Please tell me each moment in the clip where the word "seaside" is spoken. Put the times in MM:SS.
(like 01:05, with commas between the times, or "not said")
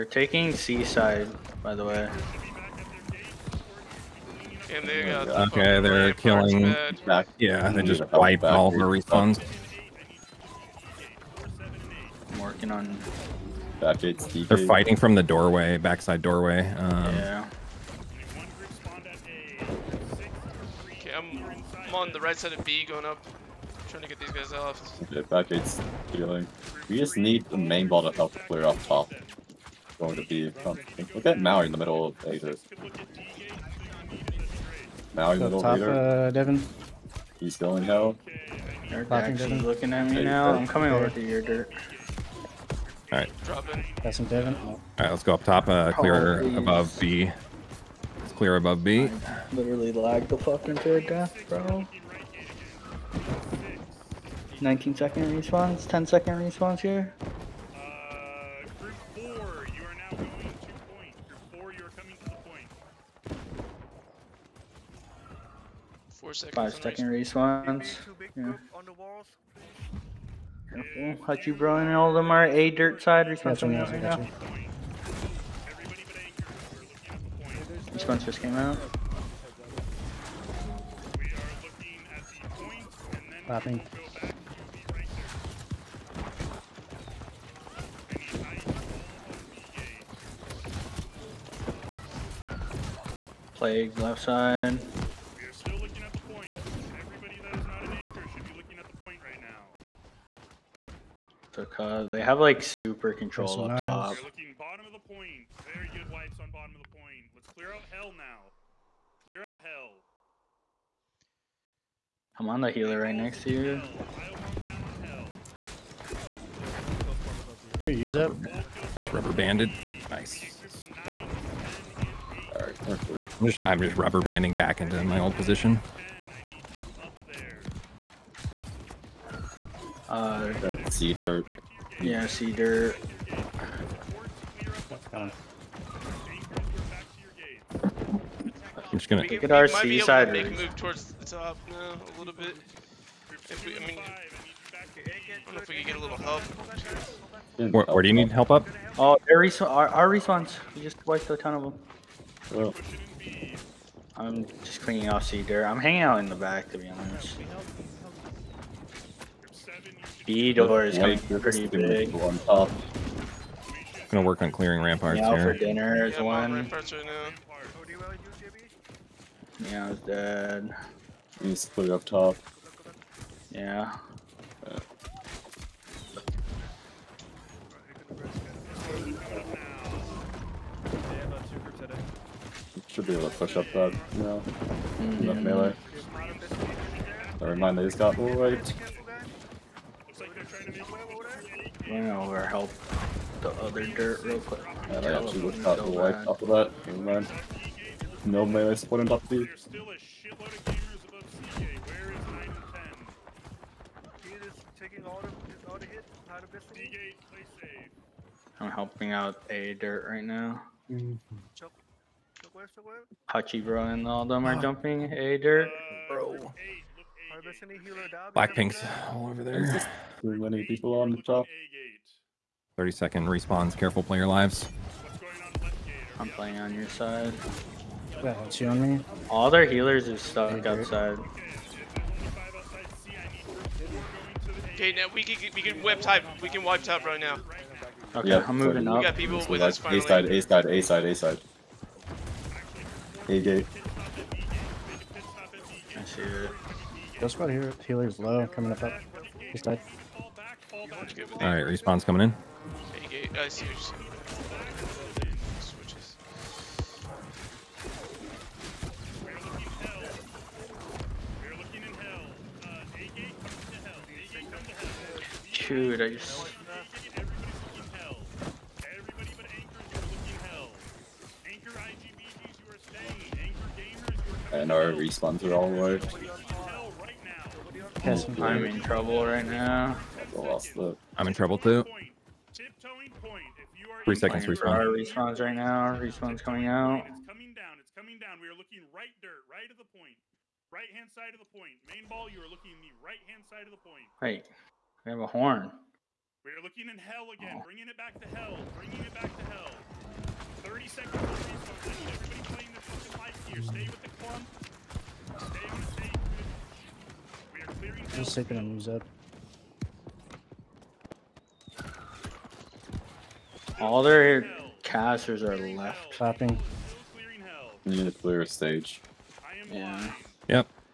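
00:00, 02:19.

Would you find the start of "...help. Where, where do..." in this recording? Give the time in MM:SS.
02:26.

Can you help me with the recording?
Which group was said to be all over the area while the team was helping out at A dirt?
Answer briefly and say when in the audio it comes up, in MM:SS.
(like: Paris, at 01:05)
Blackpink, at 03:38.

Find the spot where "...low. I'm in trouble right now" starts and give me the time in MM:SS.
04:35.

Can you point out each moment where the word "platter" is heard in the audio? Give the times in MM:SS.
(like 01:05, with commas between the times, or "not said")
not said.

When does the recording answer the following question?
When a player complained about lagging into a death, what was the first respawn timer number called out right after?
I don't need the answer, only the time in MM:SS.
00:54.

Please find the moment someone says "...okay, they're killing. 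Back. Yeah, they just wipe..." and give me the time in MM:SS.
00:05.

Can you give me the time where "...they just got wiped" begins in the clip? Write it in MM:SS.
03:07.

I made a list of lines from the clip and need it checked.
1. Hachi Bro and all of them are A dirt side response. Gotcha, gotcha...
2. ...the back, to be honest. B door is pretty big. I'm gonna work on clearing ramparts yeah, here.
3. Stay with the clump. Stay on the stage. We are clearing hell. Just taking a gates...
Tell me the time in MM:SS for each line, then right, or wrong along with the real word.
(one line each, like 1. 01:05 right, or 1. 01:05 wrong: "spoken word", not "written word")
1. 01:11 right
2. 02:36 right
3. 05:03 wrong: "moves", not "gates".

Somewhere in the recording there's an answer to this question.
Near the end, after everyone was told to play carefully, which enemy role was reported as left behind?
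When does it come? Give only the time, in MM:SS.
05:14.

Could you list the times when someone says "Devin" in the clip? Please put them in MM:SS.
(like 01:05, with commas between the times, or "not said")
00:36, 00:44.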